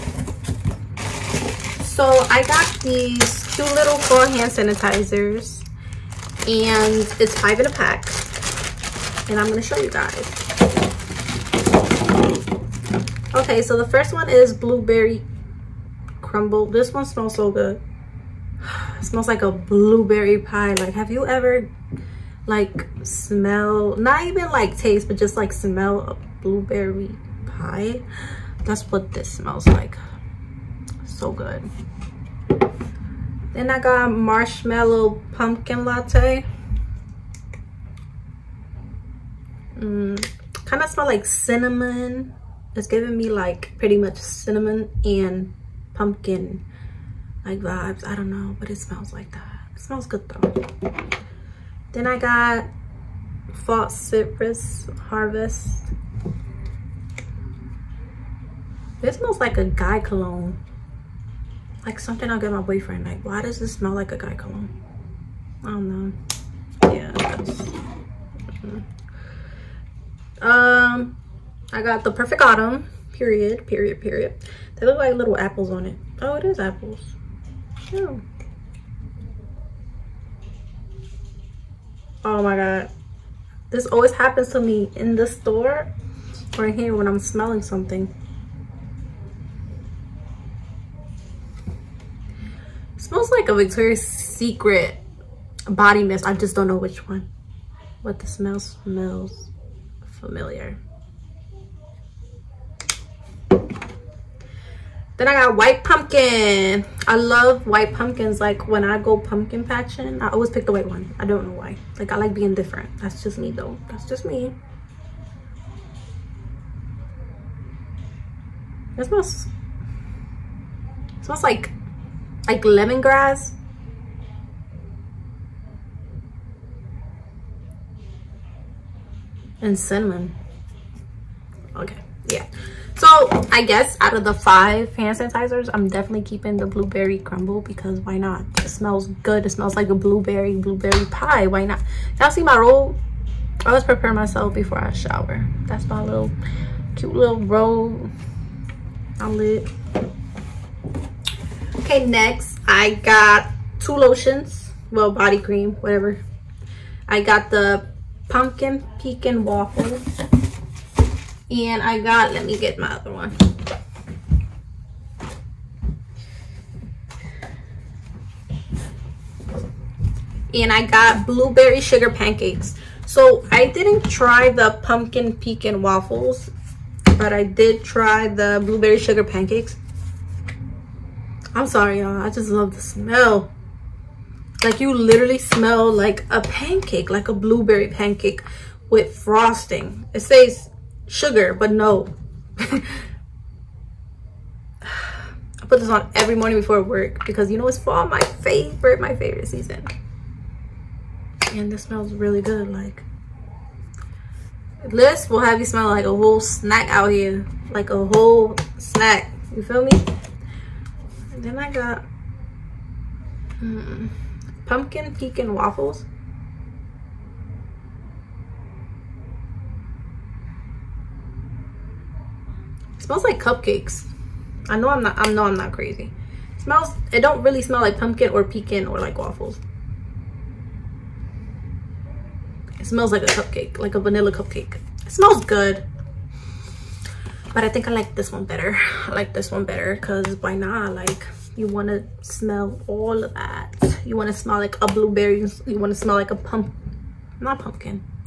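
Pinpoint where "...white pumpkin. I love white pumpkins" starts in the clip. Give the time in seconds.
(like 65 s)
105 s.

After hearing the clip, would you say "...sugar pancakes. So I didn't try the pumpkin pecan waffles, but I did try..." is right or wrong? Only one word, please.
right.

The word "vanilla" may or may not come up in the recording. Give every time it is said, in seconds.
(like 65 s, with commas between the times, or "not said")
233 s.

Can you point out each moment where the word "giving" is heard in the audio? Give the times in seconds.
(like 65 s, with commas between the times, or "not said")
42 s.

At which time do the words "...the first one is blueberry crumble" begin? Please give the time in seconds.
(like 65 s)
13 s.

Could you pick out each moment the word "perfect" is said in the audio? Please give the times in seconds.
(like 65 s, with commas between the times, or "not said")
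72 s.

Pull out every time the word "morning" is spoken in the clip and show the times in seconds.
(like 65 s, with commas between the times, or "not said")
196 s.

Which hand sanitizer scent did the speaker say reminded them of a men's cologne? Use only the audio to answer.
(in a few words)
Citrus Harvest.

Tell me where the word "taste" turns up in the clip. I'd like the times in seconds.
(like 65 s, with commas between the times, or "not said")
24 s.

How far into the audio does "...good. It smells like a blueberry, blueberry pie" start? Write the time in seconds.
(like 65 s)
139 s.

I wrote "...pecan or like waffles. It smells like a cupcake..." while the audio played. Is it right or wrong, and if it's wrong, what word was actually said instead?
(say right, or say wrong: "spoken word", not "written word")
right.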